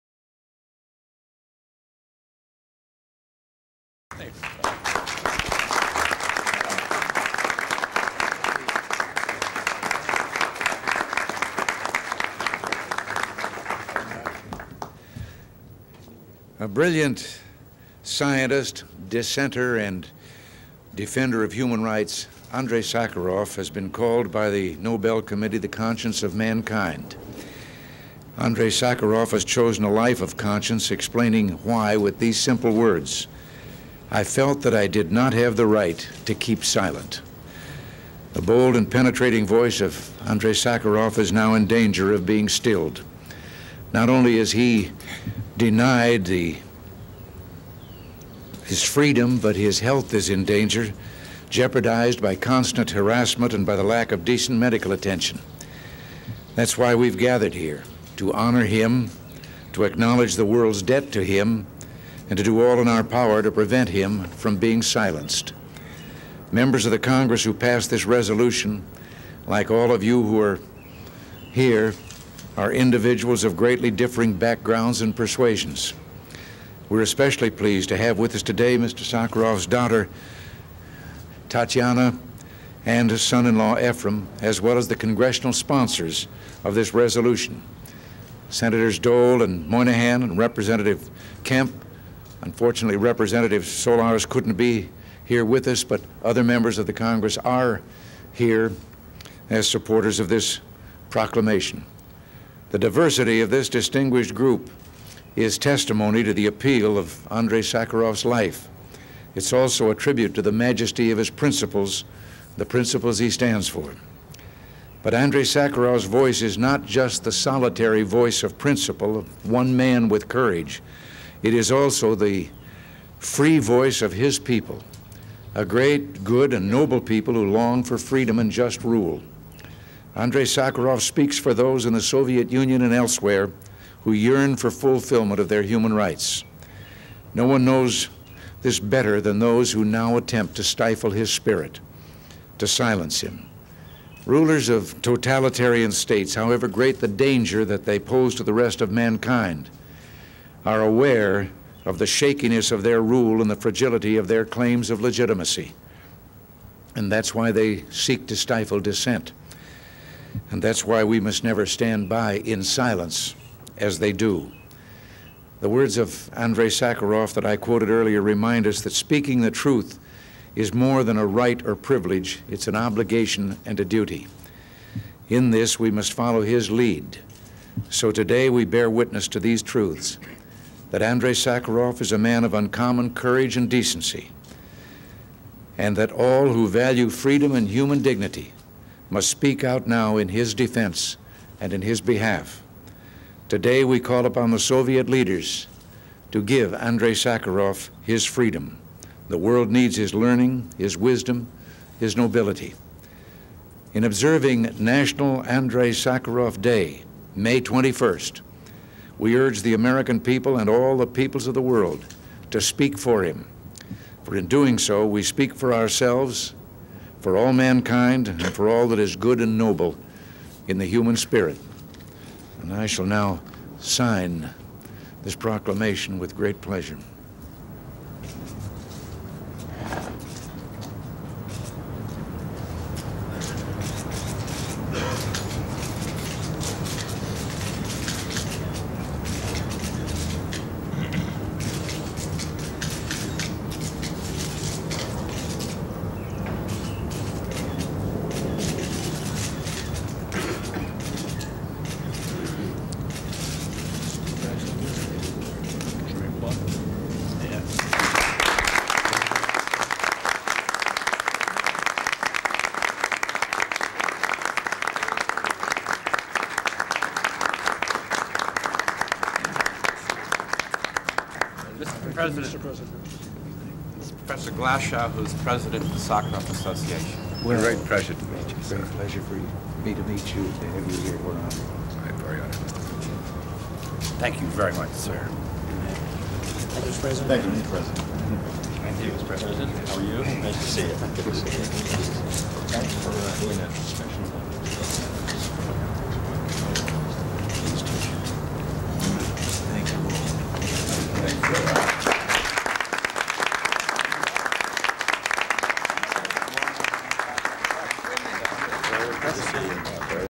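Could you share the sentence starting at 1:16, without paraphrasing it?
We're especially pleased to have with us today Mr.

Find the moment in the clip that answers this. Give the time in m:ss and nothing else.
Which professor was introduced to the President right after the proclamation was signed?
4:34.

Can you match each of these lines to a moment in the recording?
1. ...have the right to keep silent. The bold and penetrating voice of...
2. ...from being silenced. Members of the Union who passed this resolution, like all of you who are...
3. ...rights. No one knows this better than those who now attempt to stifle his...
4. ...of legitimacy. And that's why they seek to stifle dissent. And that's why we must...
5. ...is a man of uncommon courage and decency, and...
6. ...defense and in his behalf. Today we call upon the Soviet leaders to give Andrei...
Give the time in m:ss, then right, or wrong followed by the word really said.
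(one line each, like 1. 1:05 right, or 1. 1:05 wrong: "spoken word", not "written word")
1. 0:35 right
2. 1:04 wrong: "Congress", not "Union"
3. 2:15 right
4. 2:34 right
5. 3:02 right
6. 3:10 right.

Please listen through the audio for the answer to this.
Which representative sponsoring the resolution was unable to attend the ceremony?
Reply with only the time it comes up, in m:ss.
1:33.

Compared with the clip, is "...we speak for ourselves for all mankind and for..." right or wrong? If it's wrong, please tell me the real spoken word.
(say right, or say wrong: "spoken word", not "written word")
right.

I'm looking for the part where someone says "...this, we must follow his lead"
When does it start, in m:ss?
2:55.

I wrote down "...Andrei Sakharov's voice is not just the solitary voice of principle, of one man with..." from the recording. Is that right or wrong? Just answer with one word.
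right.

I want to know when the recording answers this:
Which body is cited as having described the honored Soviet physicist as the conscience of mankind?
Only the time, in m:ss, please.
0:24.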